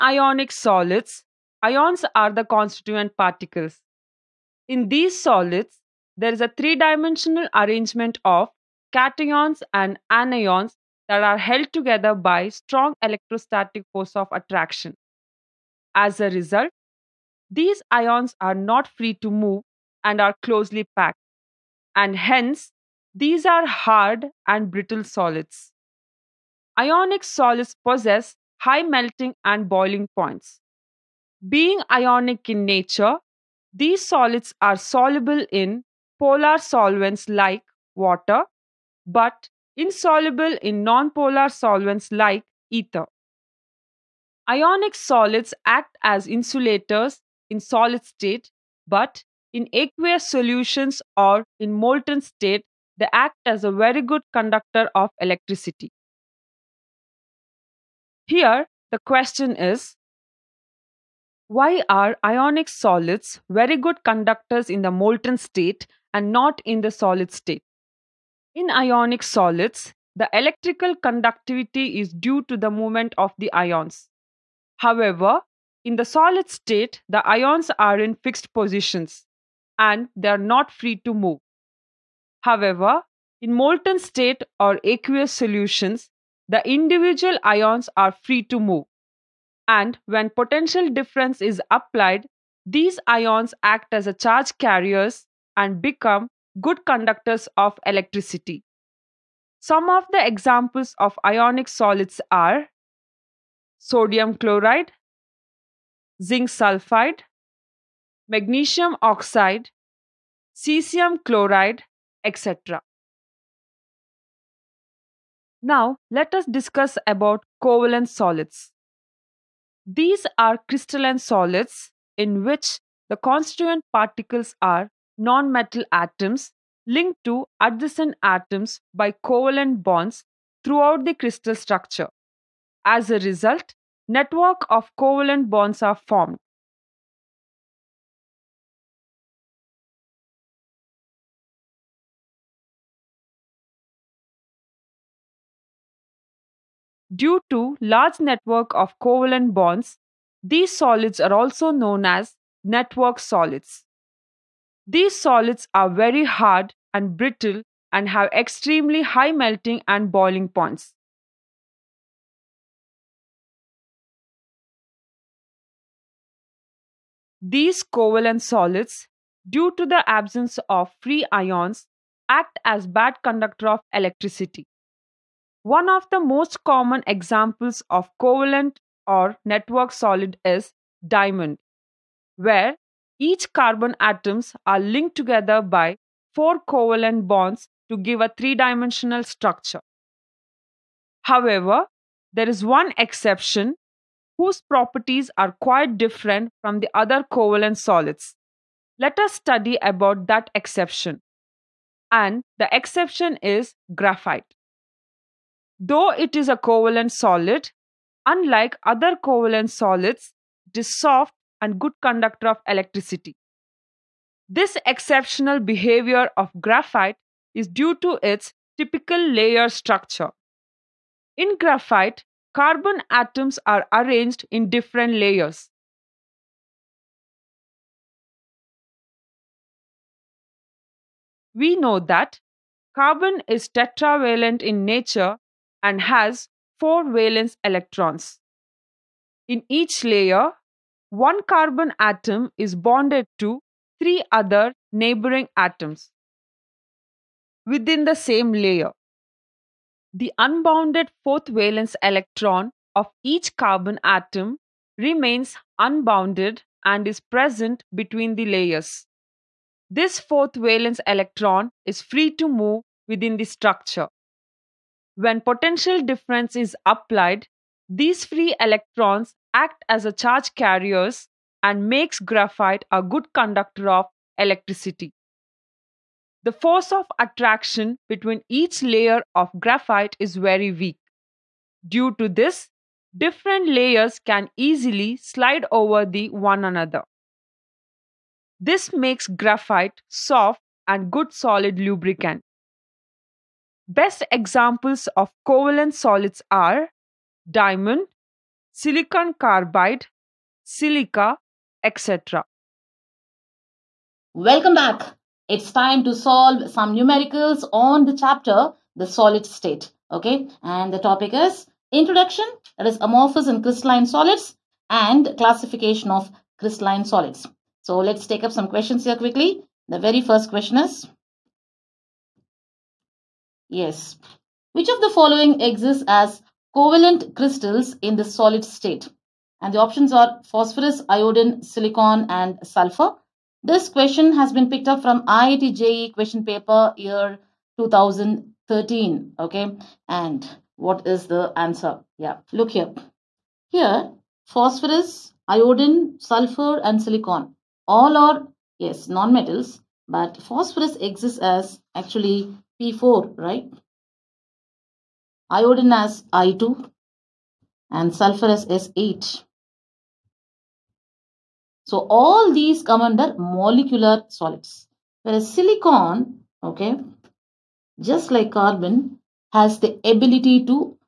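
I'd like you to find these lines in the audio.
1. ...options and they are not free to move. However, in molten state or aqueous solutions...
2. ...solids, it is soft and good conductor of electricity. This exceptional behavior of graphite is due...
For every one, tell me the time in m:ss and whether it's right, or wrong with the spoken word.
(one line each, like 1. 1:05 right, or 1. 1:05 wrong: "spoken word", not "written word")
1. 1:18 wrong: "positions", not "options"
2. 3:29 right.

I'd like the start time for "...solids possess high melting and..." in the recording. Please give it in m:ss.
0:27.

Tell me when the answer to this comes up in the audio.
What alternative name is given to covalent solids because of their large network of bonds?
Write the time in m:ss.
2:32.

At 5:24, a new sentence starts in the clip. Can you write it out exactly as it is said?
Which of the following exists as covalent crystals in the solid state?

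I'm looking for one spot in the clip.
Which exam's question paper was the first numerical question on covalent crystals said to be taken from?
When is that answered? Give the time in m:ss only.
5:35.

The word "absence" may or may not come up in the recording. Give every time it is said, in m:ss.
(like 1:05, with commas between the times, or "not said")
2:50.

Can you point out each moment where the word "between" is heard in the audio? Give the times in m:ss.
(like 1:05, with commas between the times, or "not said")
4:17, 4:38.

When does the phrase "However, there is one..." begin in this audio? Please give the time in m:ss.
3:11.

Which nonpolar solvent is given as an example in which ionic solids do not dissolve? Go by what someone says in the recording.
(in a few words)
ether.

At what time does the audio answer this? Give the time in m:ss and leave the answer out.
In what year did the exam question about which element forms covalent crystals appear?
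5:37.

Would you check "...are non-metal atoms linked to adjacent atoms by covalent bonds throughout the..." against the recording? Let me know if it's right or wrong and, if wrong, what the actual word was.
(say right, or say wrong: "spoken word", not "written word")
right.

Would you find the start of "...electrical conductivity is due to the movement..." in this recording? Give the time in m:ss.
1:10.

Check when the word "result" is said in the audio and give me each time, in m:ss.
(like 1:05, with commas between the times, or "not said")
0:16, 2:13.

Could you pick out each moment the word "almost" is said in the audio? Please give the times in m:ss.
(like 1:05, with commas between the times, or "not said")
not said.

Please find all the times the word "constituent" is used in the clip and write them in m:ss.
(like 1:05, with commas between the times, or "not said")
0:02, 2:03.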